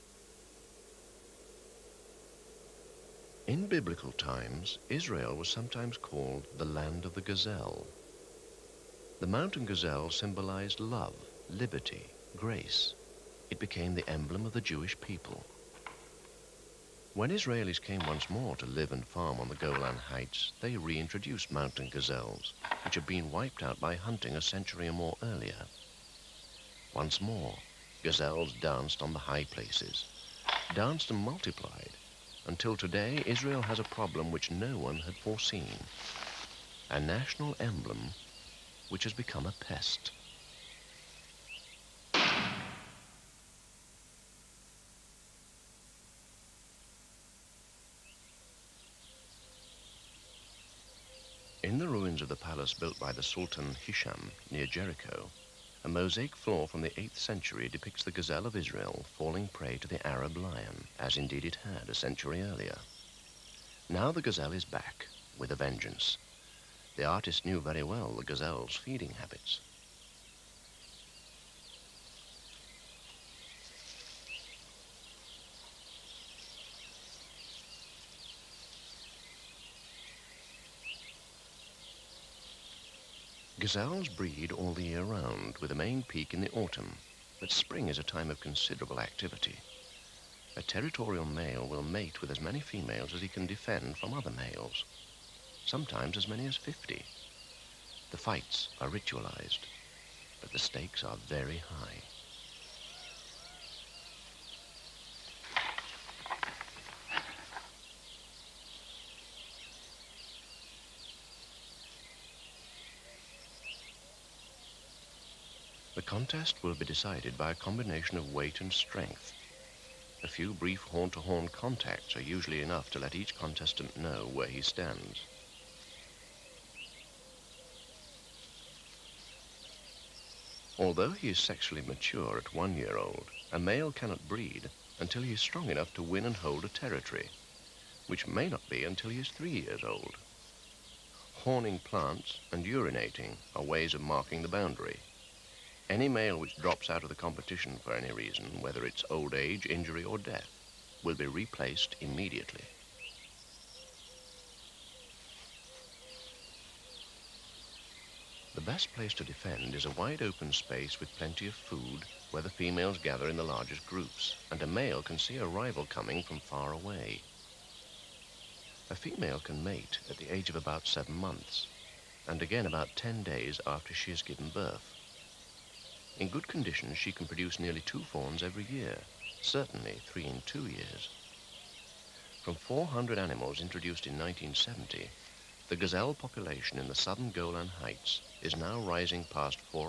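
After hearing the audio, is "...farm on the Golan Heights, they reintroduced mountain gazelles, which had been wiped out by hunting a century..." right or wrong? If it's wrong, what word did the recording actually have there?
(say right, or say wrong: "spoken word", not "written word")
right.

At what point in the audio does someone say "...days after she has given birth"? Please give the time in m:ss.
2:53.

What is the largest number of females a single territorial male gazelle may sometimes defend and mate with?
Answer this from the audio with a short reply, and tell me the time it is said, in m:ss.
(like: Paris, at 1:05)
50, at 1:36.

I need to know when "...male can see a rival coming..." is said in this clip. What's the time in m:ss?
2:44.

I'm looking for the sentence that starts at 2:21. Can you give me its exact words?
Horning plants and urinating are ways of marking the boundary.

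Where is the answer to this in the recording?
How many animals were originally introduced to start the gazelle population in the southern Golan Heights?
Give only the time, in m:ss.
3:02.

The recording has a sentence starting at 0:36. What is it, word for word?
A national emblem which has become a pest.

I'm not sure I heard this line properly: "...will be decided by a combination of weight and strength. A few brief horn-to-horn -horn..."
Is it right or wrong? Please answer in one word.
right.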